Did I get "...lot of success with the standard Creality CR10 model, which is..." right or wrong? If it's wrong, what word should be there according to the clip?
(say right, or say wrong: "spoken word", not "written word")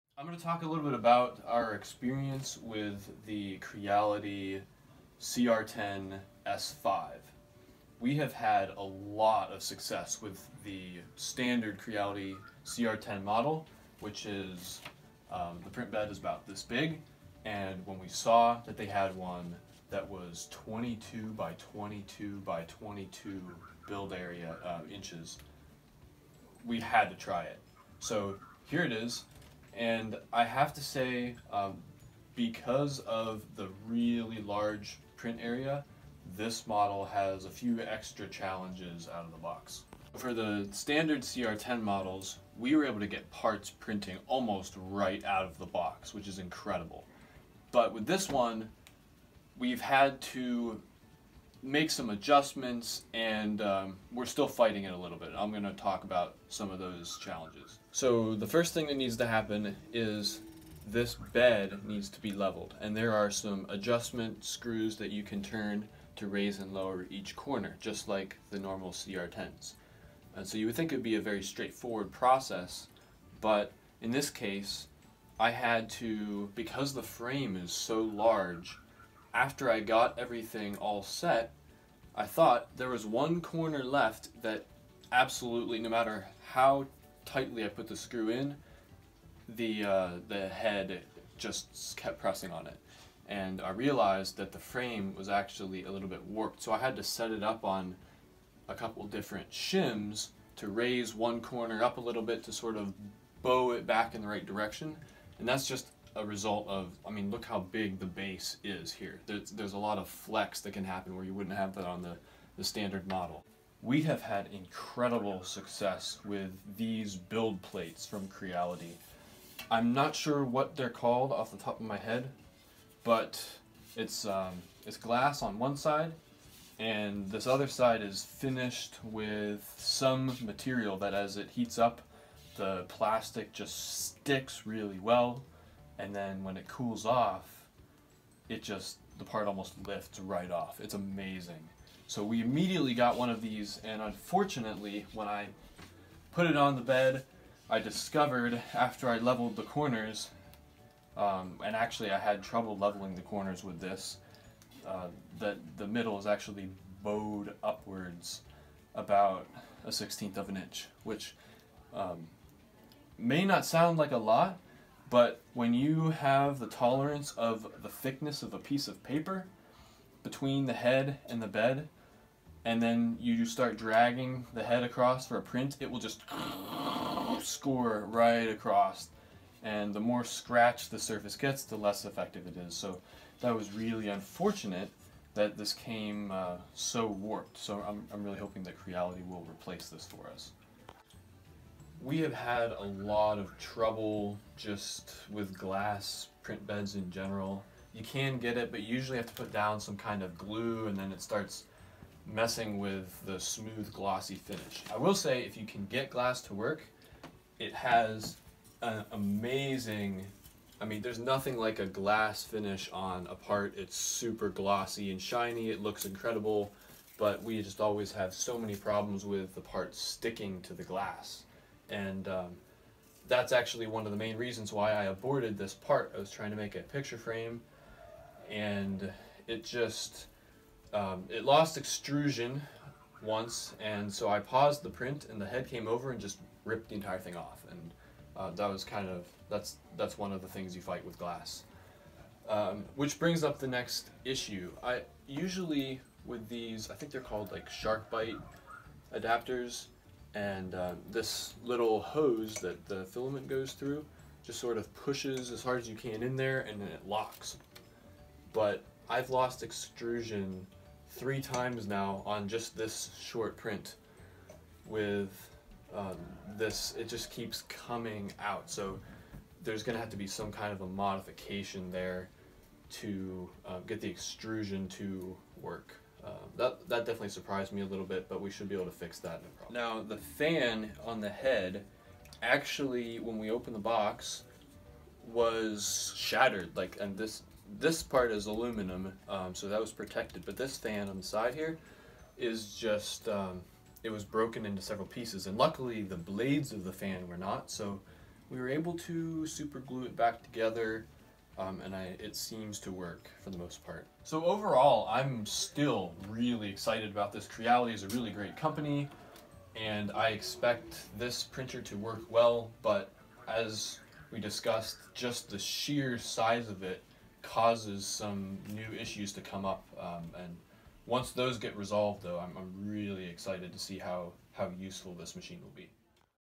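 right.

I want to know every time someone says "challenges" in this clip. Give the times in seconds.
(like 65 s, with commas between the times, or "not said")
38 s, 57 s.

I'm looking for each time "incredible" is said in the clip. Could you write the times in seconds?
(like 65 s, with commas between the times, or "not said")
46 s, 114 s, 216 s.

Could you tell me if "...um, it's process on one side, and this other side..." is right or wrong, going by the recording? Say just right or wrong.
wrong.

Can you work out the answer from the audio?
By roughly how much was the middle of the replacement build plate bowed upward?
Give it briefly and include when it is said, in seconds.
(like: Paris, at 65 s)
a sixteenth of an inch, at 159 s.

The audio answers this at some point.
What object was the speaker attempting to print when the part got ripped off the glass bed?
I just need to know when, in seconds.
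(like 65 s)
226 s.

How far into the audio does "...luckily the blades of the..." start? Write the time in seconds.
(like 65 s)
295 s.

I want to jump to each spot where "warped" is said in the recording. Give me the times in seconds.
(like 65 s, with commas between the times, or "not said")
96 s, 187 s.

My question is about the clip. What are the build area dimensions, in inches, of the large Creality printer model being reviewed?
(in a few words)
22 by 22 by 22.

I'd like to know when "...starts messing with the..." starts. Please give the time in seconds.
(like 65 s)
201 s.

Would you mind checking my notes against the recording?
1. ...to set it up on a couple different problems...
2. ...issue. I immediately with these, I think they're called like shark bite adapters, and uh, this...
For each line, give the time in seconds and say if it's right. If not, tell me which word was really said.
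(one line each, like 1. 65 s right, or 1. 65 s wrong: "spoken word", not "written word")
1. 96 s wrong: "shims", not "problems"
2. 244 s wrong: "usually", not "immediately".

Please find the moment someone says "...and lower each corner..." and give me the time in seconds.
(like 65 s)
66 s.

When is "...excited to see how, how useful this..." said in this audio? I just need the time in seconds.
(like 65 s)
323 s.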